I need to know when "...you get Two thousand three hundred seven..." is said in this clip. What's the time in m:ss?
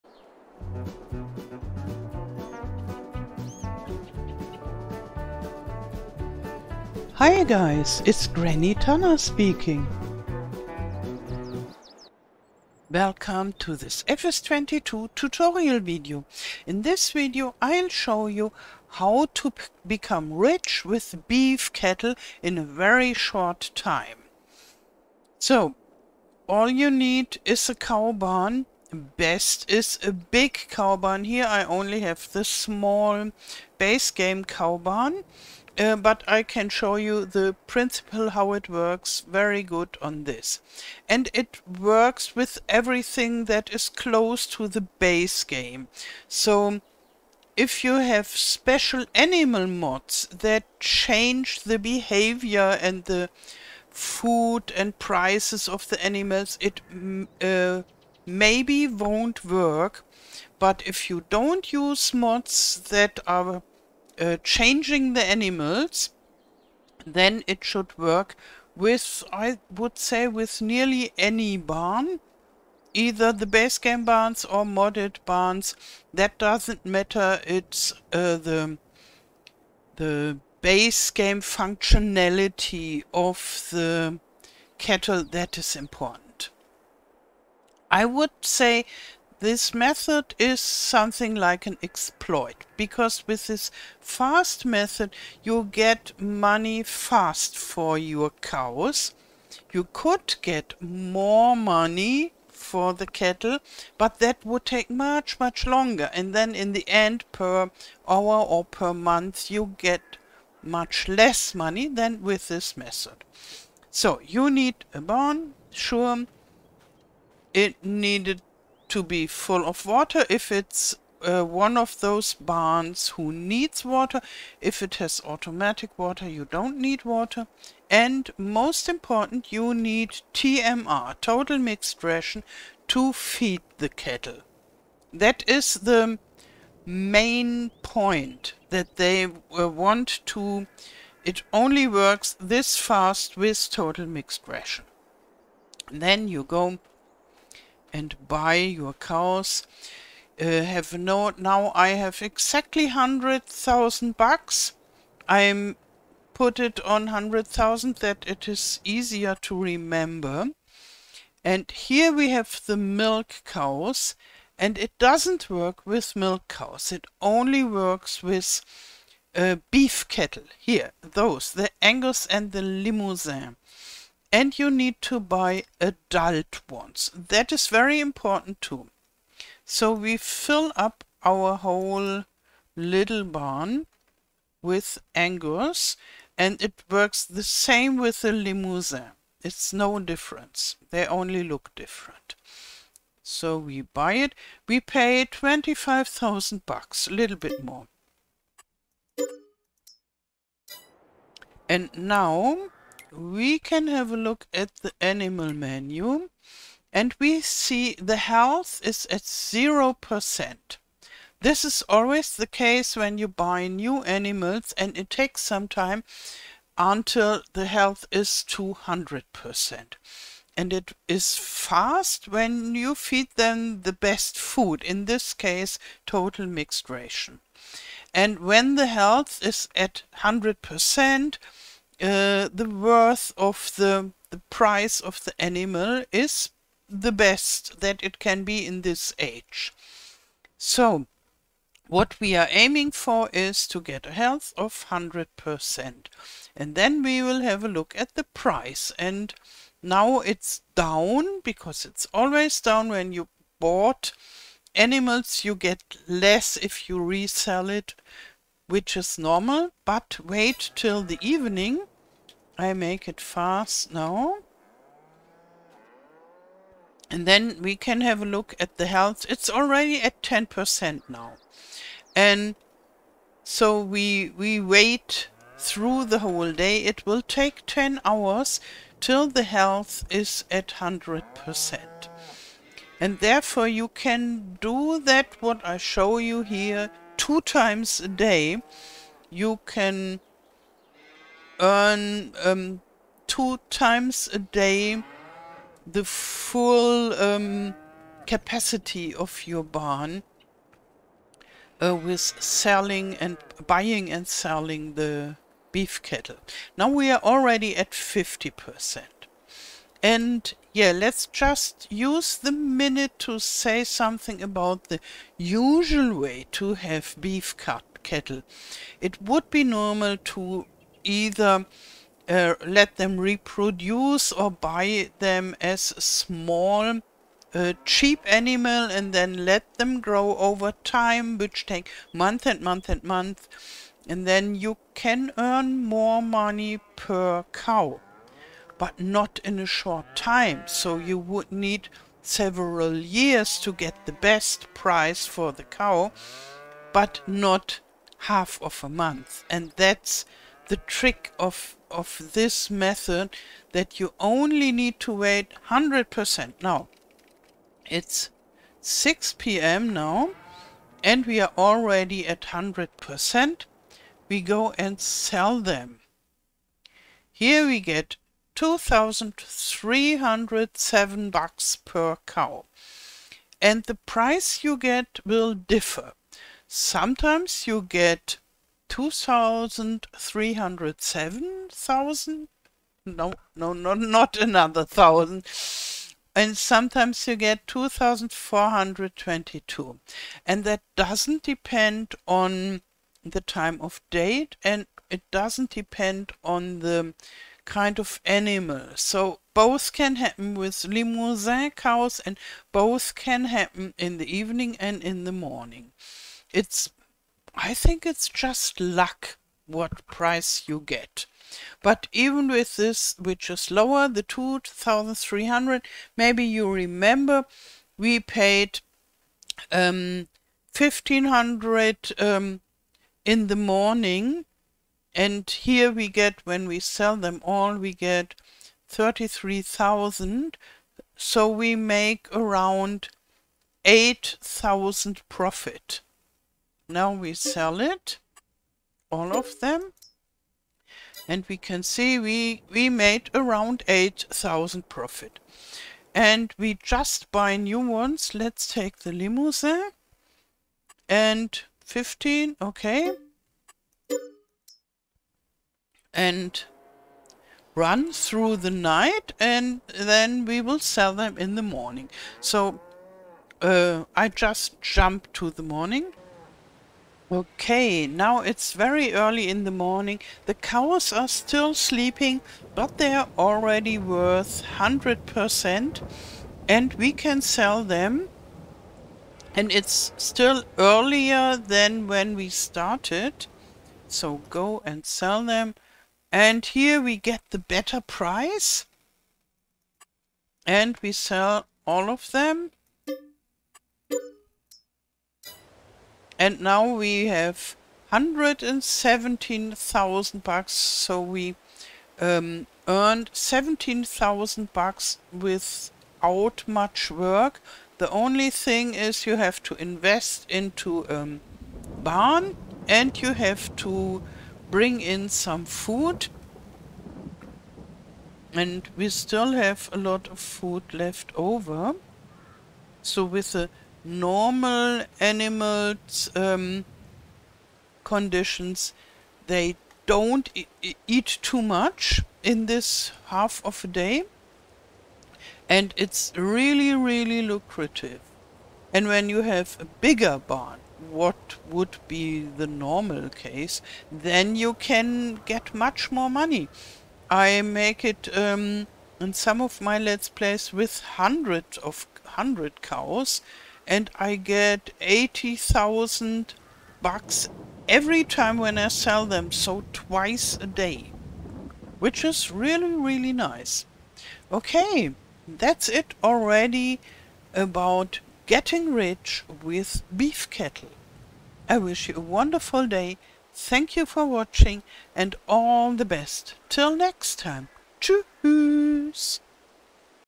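6:17.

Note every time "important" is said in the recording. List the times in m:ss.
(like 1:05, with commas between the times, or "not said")
1:25, 2:08, 2:57.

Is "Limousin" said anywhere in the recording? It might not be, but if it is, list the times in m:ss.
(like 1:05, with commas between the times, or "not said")
2:52, 3:08, 6:40, 7:29.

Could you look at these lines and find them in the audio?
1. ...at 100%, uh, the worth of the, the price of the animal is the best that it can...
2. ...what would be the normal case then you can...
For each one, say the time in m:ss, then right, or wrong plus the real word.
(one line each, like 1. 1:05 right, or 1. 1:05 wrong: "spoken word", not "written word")
1. 3:49 right
2. 9:01 right.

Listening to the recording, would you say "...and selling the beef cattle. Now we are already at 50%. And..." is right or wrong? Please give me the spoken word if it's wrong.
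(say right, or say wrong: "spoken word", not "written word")
right.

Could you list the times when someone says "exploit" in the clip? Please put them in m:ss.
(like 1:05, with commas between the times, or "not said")
1:31.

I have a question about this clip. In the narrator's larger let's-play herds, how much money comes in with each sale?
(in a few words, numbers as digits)
80,000.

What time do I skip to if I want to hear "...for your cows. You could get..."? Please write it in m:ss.
1:37.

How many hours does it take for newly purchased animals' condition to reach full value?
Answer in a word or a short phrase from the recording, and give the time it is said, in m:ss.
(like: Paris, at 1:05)
10, at 4:37.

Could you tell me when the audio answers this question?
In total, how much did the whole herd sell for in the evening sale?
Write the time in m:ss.
7:08.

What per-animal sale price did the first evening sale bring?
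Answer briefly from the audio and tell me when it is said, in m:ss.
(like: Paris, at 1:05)
2,307, at 6:08.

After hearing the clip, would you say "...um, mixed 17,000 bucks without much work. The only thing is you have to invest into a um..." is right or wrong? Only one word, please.
wrong.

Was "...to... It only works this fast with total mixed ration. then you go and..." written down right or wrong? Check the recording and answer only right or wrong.
right.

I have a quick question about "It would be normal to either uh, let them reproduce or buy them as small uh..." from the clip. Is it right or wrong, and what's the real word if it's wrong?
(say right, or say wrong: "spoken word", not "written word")
right.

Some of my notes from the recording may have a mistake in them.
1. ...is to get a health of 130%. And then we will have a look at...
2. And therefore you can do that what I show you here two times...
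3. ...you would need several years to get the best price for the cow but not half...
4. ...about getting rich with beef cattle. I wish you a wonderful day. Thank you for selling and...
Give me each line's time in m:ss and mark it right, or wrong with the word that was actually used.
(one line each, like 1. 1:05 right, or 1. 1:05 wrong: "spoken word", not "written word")
1. 4:03 wrong: "100", not "130"
2. 4:42 right
3. 5:40 right
4. 9:27 wrong: "watching", not "selling".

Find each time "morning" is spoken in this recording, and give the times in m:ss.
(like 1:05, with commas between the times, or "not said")
6:45, 7:03, 7:41, 7:45, 7:49.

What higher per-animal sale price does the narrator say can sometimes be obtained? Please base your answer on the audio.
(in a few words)
2,422.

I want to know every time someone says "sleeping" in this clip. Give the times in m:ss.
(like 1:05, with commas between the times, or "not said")
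7:51.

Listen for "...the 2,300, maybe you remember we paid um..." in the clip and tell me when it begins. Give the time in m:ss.
6:54.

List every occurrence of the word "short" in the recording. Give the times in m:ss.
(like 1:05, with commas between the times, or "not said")
0:23, 5:39.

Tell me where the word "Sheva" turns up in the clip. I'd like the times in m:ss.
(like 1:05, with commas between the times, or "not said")
not said.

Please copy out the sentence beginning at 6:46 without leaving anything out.
It's I think it's just luck what price you get.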